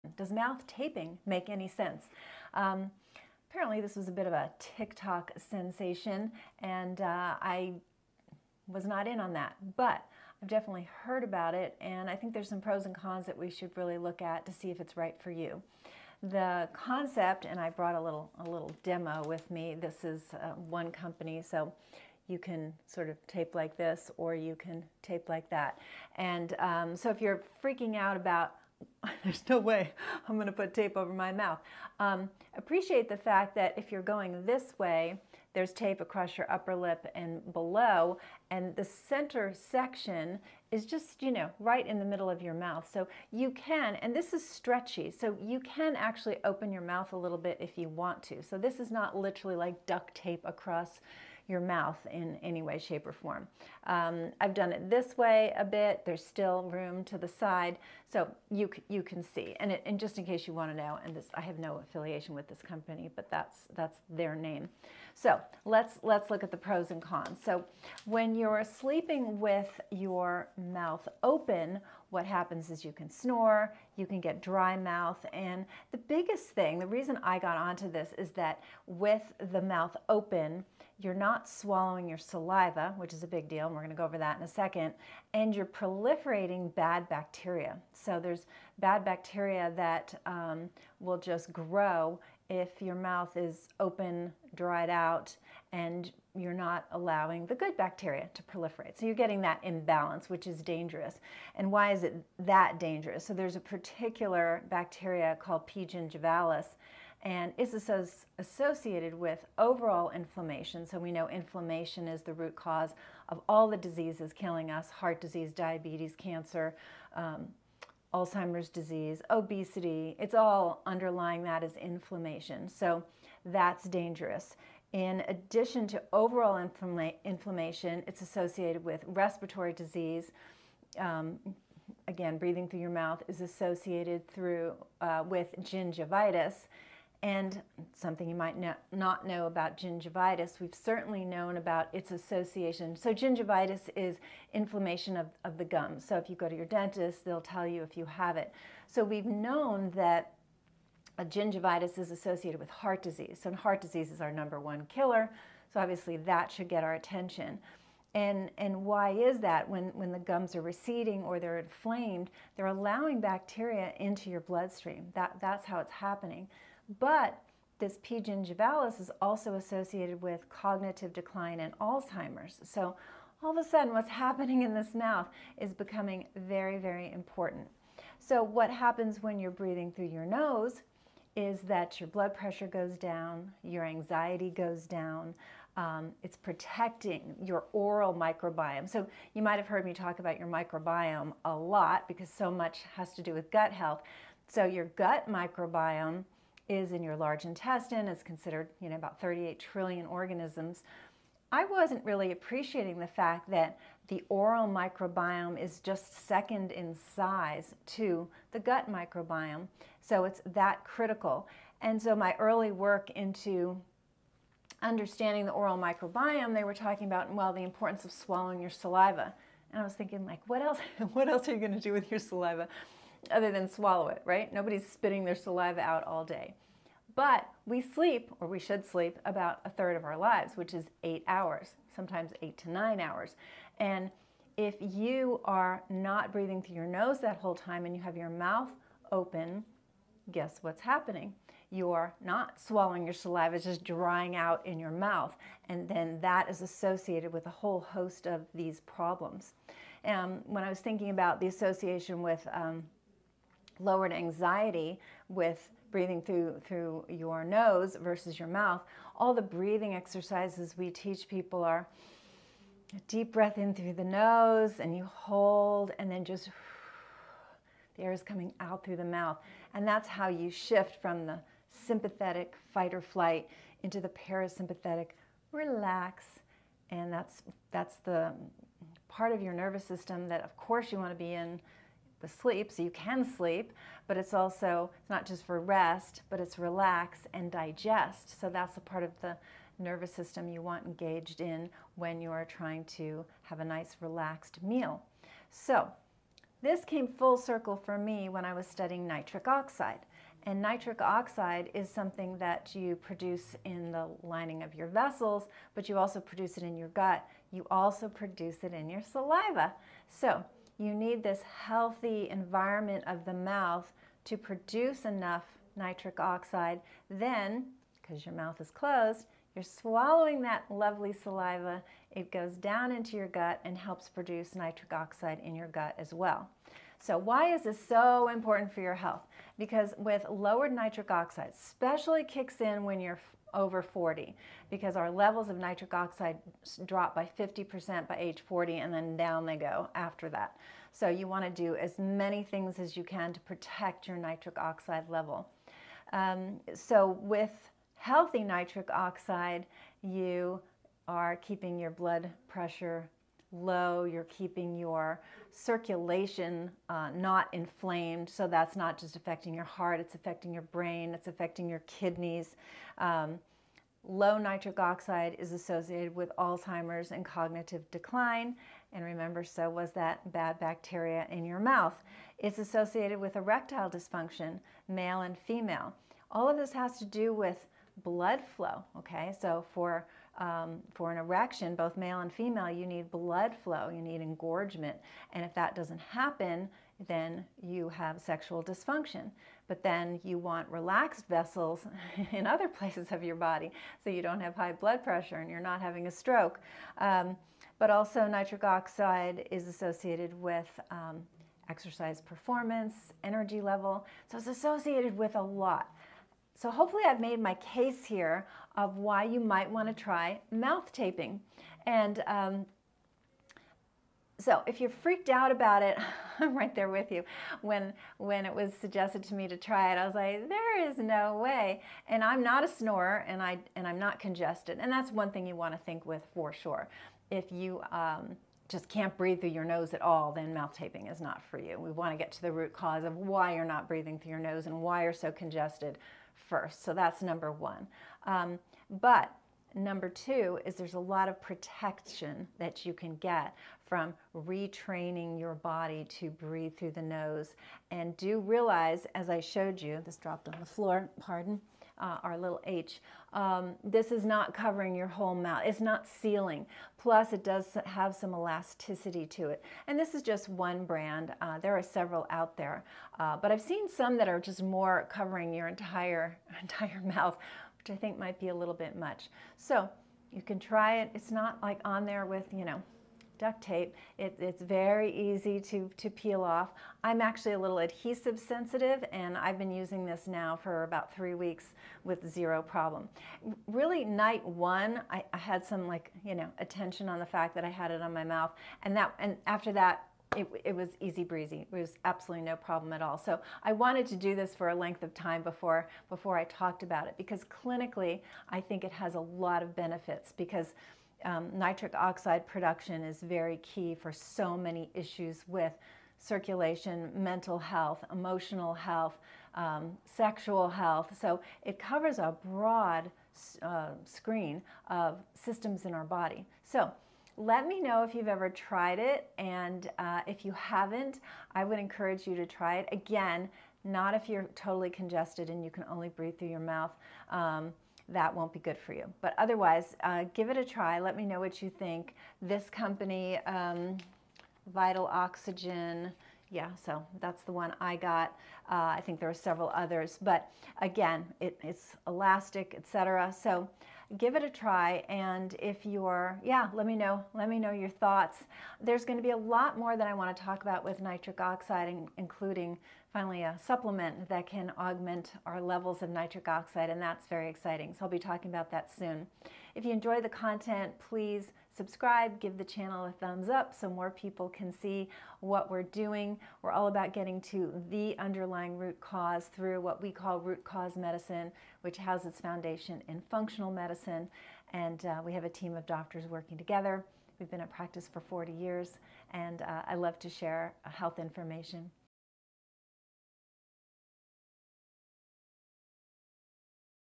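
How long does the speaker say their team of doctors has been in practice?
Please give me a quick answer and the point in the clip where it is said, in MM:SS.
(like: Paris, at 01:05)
40 years, at 09:38.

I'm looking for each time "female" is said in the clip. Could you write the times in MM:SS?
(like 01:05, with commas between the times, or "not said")
06:15, 06:22.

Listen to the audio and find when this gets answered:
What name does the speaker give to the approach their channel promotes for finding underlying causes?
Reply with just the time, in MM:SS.
09:30.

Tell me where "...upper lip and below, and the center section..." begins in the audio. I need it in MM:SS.
00:36.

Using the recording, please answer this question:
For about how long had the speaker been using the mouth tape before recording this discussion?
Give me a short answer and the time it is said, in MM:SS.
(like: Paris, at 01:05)
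about three weeks, at 08:00.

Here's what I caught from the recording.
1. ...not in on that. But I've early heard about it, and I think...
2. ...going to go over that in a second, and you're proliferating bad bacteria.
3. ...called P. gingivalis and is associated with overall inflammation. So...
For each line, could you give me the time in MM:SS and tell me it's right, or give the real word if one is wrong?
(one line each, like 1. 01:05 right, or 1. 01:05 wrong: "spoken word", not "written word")
1. 00:08 wrong: "definitely", not "early"
2. 01:23 right
3. 01:45 right.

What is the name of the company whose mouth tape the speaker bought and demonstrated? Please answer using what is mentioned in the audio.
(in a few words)
Vital Oxygen.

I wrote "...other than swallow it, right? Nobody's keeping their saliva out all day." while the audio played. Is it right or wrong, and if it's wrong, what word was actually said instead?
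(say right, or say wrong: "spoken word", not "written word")
wrong: "spitting", not "keeping".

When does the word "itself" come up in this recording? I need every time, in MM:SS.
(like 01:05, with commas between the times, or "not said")
not said.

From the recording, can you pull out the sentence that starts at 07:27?
And do realize, as I showed you, this dropped on the floor, pardon, uh, our little H.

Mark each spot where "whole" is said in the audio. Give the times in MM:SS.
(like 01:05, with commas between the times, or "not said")
03:57, 04:07, 07:35.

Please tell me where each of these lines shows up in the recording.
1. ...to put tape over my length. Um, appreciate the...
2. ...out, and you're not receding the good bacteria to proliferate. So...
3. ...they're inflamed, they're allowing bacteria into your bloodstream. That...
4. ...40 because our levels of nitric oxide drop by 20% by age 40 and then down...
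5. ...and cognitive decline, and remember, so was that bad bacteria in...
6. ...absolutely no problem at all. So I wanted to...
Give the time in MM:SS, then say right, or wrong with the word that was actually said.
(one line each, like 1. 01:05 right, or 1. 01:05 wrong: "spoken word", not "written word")
1. 00:30 wrong: "mouth", not "length"
2. 01:34 wrong: "allowing", not "receding"
3. 02:41 right
4. 05:33 wrong: "50", not "20"
5. 06:07 right
6. 08:12 right.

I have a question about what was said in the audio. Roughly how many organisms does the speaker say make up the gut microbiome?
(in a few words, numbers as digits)
38 trillion.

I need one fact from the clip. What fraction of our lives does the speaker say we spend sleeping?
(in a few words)
a third.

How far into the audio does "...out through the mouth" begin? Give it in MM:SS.
04:28.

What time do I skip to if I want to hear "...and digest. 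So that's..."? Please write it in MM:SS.
04:47.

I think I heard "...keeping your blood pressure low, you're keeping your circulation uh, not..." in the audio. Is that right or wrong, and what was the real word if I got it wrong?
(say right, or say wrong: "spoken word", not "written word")
right.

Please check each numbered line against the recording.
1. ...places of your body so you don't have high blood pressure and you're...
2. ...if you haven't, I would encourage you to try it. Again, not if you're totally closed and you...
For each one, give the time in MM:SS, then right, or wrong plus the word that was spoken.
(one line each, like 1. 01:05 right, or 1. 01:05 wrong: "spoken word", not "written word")
1. 06:32 right
2. 08:40 wrong: "congested", not "closed".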